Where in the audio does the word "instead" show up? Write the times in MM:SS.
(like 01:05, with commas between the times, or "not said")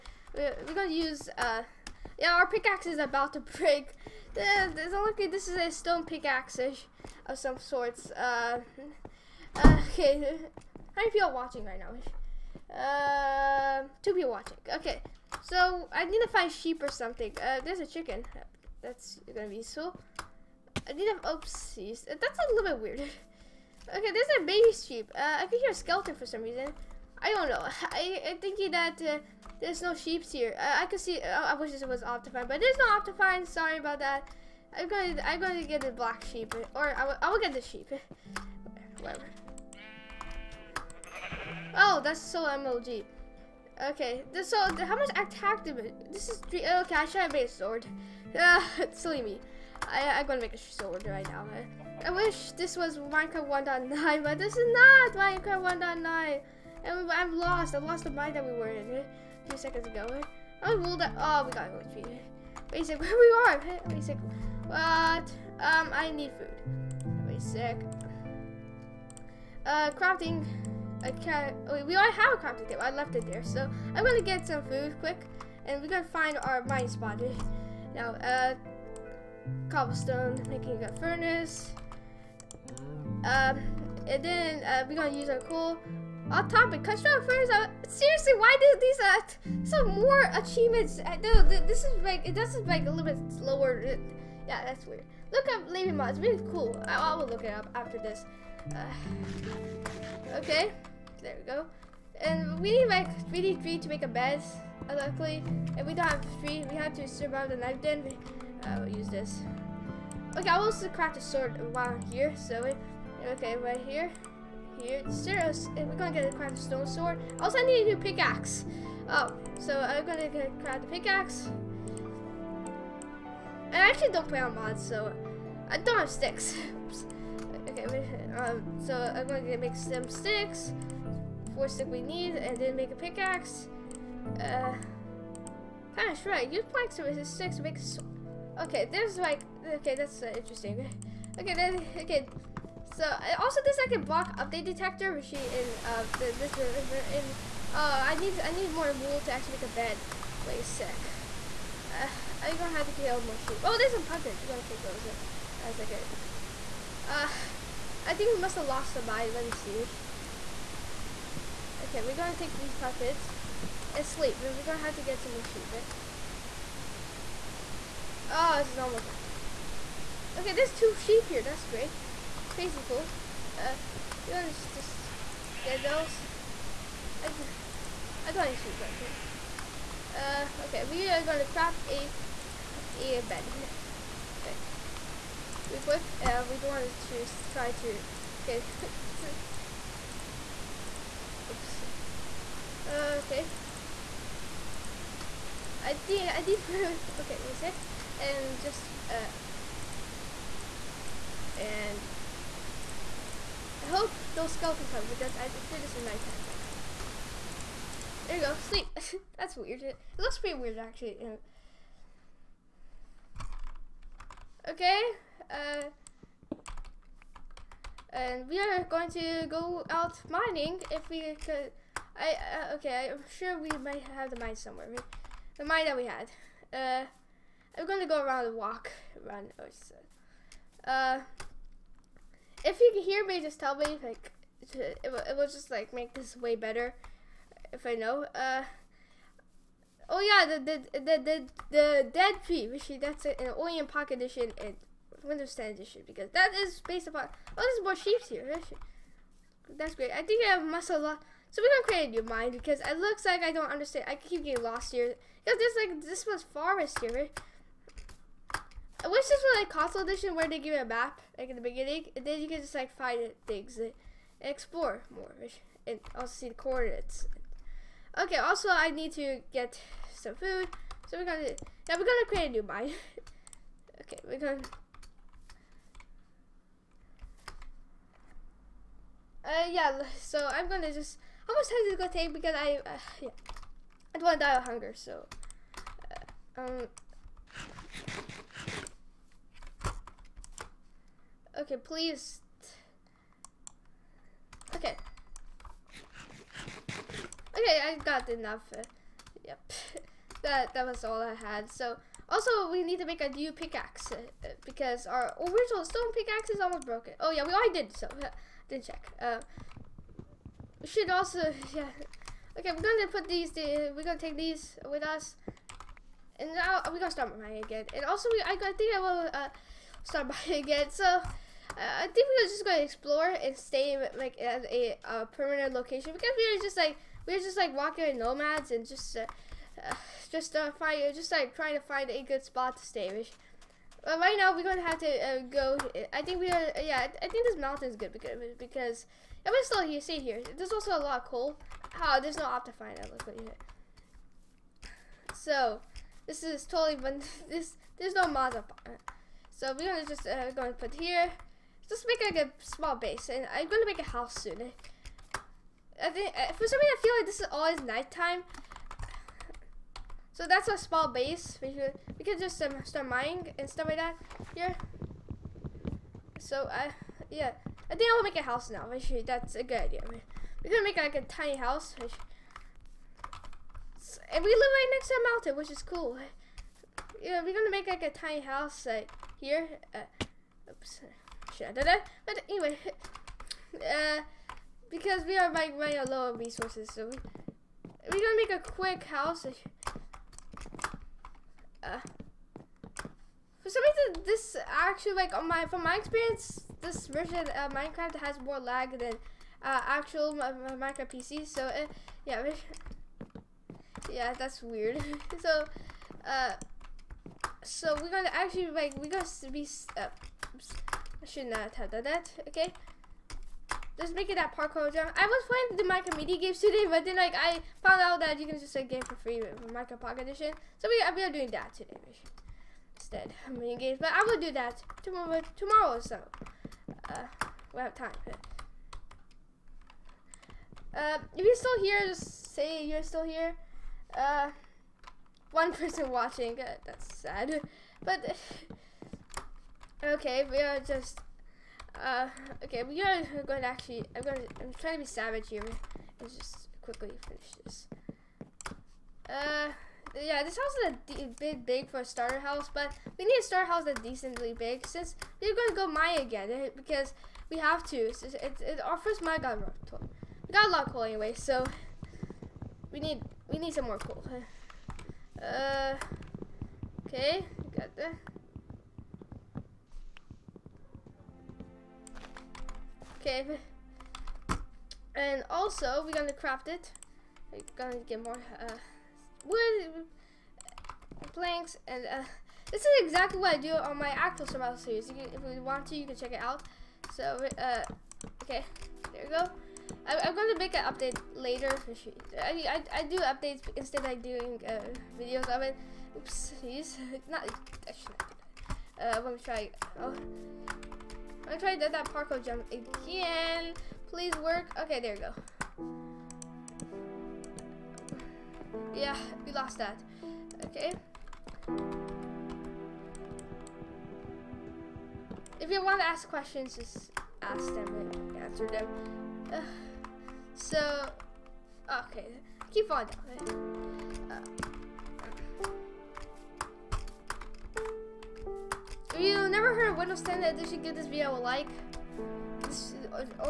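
07:02, 08:13.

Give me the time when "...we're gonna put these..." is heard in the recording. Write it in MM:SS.
05:12.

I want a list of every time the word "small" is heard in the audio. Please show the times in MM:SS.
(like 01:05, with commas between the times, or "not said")
05:52, 06:00.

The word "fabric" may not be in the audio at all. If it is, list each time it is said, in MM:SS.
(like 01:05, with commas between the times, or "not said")
not said.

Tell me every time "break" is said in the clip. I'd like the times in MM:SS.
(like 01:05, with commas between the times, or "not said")
00:03.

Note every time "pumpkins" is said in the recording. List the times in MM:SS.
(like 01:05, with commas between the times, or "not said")
02:34, 02:42.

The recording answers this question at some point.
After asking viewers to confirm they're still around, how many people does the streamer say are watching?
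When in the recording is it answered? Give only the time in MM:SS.
07:15.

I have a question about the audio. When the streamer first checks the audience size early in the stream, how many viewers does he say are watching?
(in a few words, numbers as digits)
2.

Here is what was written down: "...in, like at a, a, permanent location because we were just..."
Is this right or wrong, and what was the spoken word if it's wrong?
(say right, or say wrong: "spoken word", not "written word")
right.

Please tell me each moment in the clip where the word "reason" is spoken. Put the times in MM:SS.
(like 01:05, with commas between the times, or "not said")
00:26, 05:56, 06:33.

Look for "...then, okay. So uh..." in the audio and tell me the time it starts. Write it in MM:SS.
02:21.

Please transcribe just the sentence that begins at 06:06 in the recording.
So I uh, yeah, I think I will make a house now.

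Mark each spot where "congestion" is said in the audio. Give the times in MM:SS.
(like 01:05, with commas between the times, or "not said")
not said.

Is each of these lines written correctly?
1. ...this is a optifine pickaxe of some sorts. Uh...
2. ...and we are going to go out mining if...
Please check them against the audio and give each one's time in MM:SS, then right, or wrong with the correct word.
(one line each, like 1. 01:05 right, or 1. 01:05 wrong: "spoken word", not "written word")
1. 00:05 wrong: "stone", not "optifine"
2. 03:38 right.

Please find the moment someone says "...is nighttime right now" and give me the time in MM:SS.
03:25.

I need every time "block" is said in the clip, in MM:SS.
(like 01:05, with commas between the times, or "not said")
02:24.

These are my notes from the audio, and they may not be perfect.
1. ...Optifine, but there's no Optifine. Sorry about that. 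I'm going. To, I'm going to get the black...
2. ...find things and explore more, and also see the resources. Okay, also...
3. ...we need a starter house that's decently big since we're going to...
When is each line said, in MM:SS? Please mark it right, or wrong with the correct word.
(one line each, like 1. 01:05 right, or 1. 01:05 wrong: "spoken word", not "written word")
1. 00:32 right
2. 04:22 wrong: "coordinates", not "resources"
3. 07:33 right.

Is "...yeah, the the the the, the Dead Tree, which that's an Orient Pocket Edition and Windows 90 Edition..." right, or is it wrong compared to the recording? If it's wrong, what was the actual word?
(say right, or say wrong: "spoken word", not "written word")
wrong: "10", not "90".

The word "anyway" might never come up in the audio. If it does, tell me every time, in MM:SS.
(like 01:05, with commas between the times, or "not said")
06:22, 07:41.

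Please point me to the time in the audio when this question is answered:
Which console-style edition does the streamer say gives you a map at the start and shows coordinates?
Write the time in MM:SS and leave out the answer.
04:19.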